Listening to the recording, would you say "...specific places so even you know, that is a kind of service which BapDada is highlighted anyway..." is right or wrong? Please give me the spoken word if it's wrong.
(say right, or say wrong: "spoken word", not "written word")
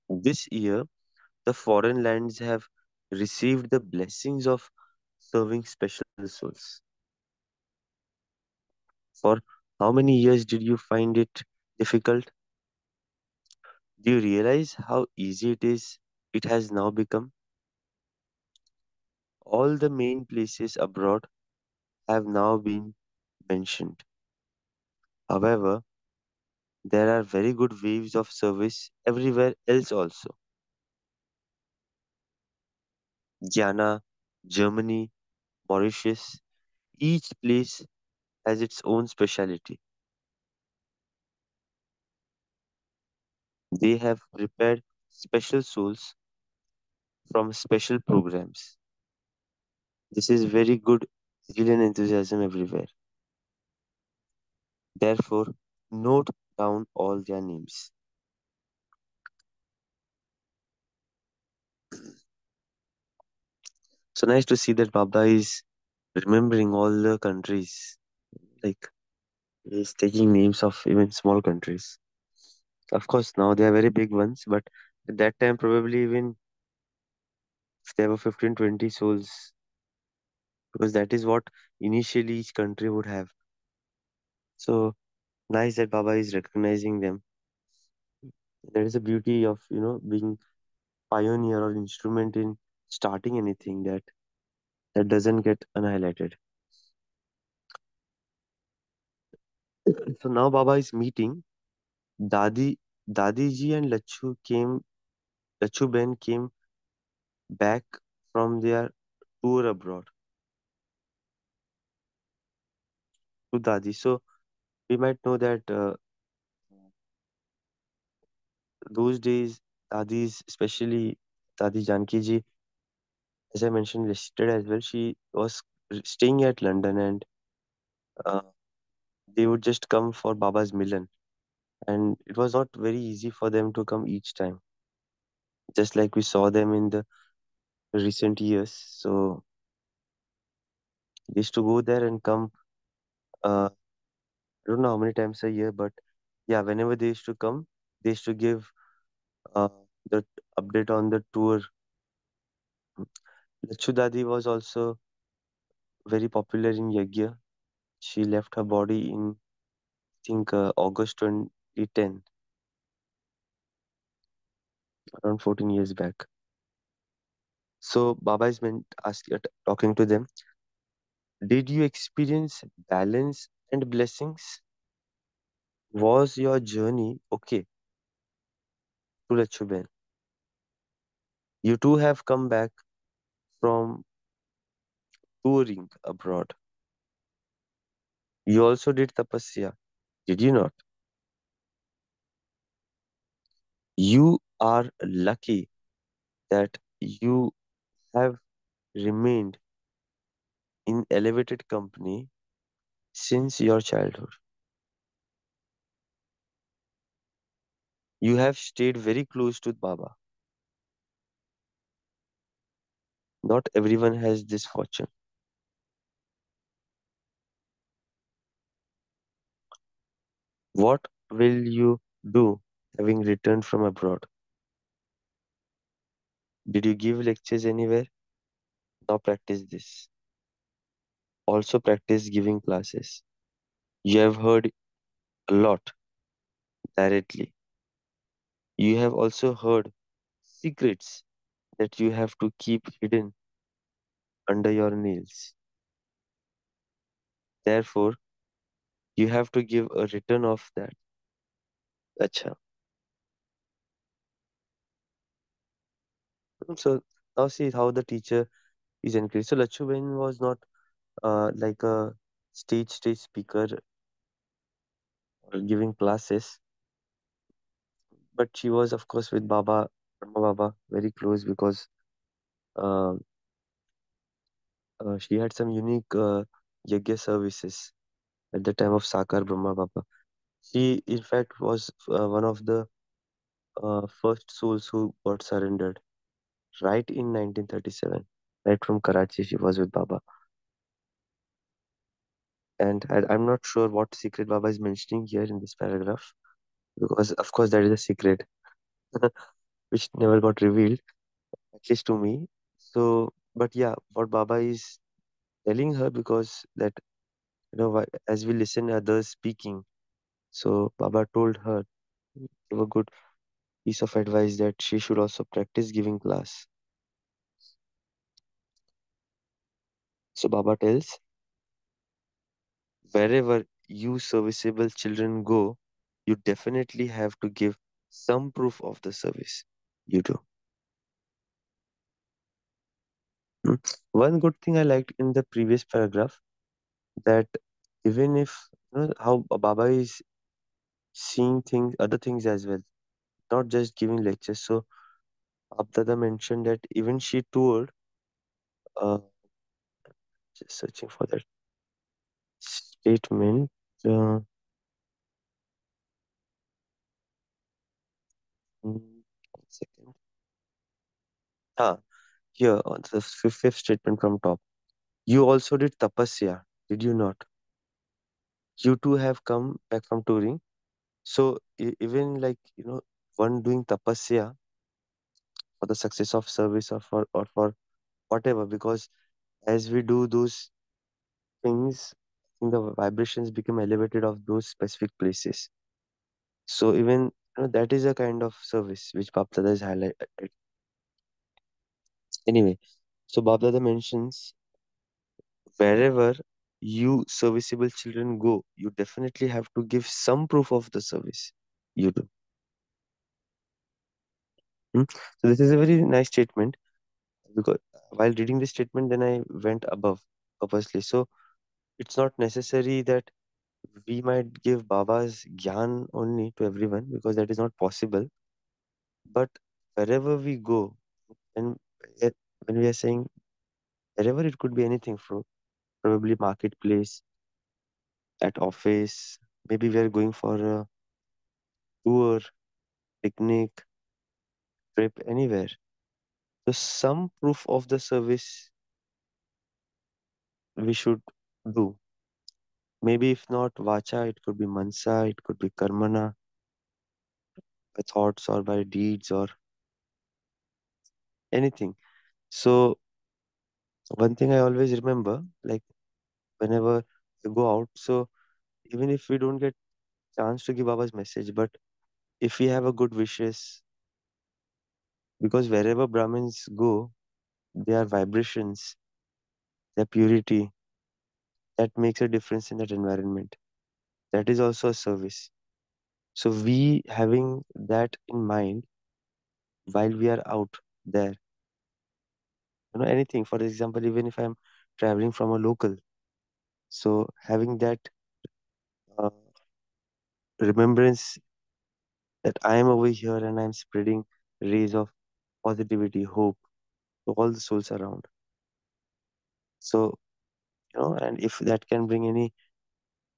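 right.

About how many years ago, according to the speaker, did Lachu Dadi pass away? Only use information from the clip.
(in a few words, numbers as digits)
14 years.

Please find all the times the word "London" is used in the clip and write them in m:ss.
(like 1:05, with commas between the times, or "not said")
2:06.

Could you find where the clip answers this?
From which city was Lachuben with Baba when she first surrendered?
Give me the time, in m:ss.
4:49.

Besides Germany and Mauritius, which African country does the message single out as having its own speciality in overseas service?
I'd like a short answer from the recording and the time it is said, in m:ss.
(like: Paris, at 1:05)
Ghana, at 0:33.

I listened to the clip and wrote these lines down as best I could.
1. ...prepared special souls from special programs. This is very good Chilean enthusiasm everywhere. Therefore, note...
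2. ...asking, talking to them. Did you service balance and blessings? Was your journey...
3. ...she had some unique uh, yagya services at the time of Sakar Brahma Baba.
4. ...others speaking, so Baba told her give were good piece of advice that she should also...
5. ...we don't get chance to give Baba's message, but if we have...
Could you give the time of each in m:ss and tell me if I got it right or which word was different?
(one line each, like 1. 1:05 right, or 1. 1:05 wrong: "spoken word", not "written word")
1. 0:44 right
2. 2:49 wrong: "experience", not "service"
3. 4:35 right
4. 5:08 right
5. 7:39 right.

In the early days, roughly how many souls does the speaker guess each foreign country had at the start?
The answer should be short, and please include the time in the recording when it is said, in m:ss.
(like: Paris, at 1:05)
15-20, at 1:18.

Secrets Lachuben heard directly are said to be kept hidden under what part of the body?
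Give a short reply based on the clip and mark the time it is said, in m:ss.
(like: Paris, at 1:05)
Nails, at 4:04.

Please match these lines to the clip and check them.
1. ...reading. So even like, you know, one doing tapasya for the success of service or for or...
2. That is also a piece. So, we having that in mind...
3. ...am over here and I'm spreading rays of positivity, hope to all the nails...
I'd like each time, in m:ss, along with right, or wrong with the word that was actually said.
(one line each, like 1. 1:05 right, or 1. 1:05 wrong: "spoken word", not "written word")
1. 6:10 wrong: "touring", not "reading"
2. 7:54 wrong: "service", not "piece"
3. 8:12 wrong: "souls", not "nails".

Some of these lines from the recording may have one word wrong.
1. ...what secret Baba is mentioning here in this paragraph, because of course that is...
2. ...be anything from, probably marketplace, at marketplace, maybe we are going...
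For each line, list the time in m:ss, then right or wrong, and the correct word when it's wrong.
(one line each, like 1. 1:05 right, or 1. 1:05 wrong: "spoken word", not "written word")
1. 4:53 right
2. 7:04 wrong: "office", not "marketplace".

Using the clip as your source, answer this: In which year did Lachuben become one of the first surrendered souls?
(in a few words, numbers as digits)
1937.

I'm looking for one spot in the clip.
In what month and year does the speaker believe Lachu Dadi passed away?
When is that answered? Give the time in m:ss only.
2:40.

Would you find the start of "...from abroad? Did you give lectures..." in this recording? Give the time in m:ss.
3:43.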